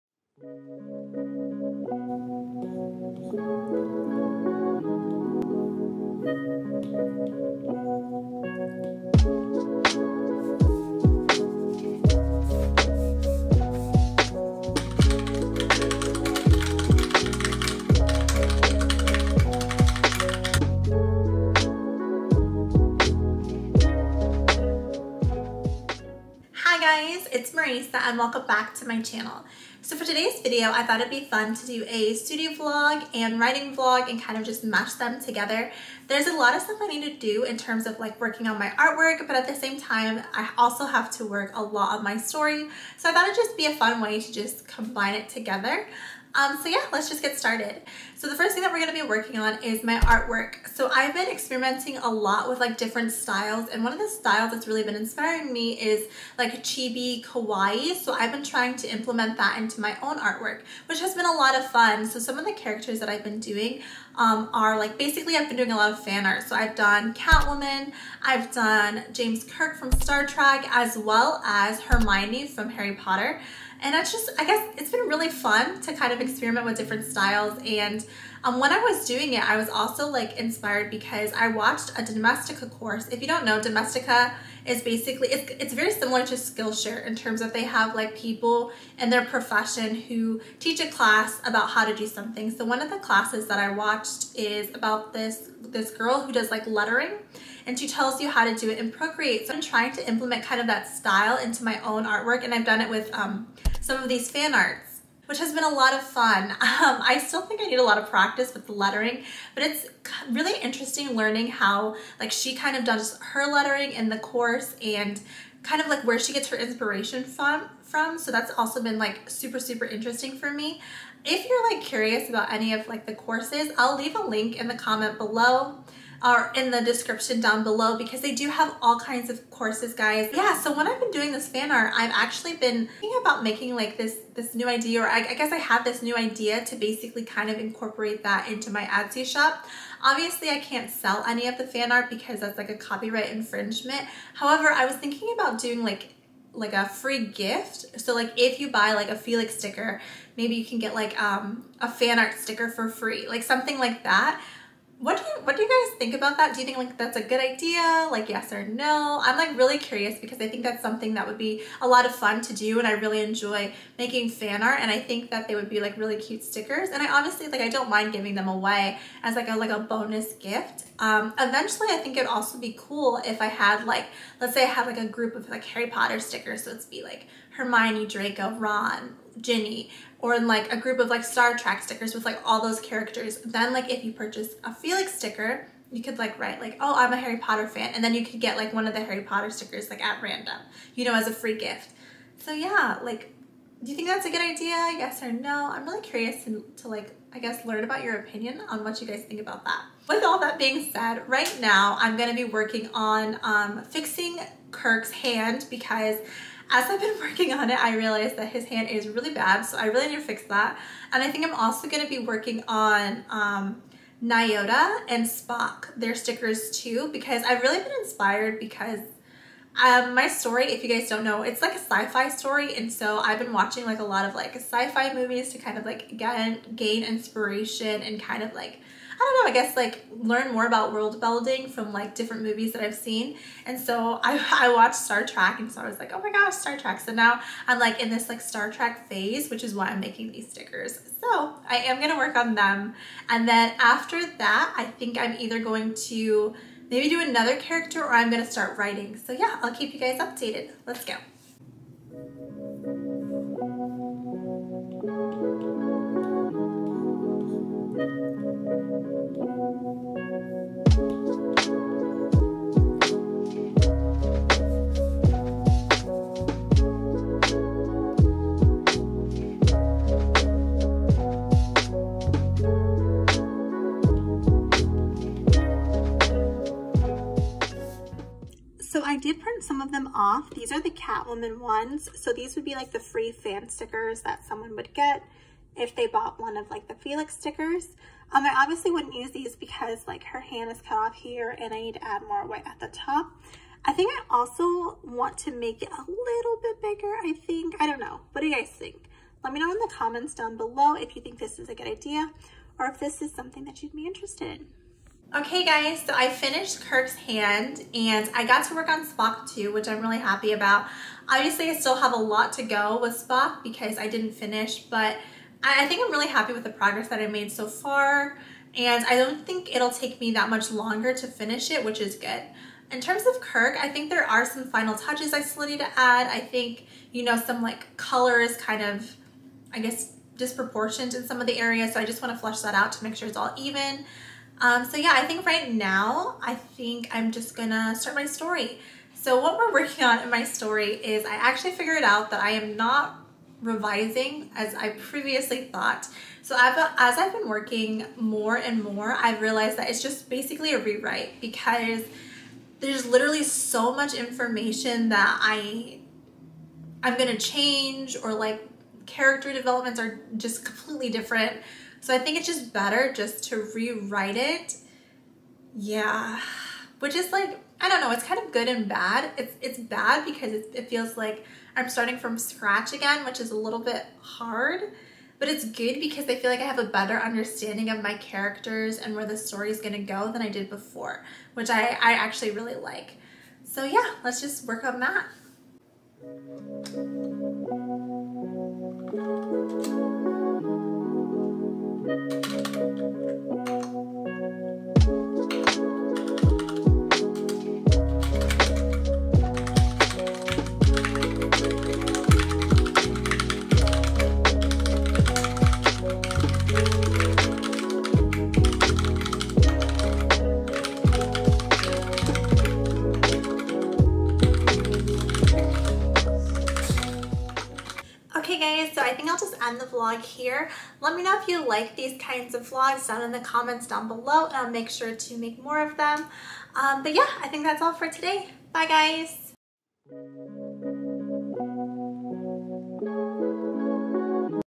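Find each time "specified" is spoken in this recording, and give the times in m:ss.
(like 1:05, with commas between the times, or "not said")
not said.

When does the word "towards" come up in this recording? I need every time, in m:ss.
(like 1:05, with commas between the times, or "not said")
not said.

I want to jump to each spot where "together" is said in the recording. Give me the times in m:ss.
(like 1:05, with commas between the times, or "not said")
0:35, 0:45.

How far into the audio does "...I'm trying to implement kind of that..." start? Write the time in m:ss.
1:39.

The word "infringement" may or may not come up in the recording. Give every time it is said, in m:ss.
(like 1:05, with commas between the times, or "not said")
2:23.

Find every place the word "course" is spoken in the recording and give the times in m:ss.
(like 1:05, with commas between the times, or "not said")
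1:22, 1:54, 2:03, 2:09.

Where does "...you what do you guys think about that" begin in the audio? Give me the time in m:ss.
2:35.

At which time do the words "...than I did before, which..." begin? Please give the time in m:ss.
6:20.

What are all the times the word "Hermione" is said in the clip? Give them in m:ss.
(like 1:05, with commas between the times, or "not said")
1:11, 2:57.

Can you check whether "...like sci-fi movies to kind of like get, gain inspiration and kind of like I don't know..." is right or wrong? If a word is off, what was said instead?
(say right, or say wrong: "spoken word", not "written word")
right.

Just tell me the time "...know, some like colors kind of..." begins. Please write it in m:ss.
5:27.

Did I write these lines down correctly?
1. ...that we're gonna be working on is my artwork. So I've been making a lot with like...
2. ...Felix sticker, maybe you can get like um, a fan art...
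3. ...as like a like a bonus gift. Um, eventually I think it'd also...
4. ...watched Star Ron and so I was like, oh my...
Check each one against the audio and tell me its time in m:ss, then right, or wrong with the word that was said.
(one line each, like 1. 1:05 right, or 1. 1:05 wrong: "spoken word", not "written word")
1. 0:48 wrong: "experimenting", not "making"
2. 2:29 right
3. 2:49 right
4. 3:54 wrong: "Trek", not "Ron".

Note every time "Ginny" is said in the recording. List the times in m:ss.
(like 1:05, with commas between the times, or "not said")
2:59.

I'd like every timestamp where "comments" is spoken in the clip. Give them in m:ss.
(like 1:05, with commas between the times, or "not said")
2:04, 4:59, 7:03.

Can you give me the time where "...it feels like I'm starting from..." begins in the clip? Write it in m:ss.
6:10.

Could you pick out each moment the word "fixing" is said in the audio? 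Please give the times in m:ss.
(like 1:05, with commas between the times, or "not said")
3:23.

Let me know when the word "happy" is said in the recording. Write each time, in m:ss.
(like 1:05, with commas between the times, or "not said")
5:10, 5:16.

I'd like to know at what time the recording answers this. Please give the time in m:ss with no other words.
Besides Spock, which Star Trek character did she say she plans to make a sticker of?
3:34.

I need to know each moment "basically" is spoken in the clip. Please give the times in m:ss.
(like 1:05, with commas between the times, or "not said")
1:04, 1:24, 2:16, 5:50.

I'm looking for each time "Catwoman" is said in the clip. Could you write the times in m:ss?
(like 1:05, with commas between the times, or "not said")
1:07, 4:40.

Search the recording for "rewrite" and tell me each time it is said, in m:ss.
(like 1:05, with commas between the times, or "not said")
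5:50, 6:03.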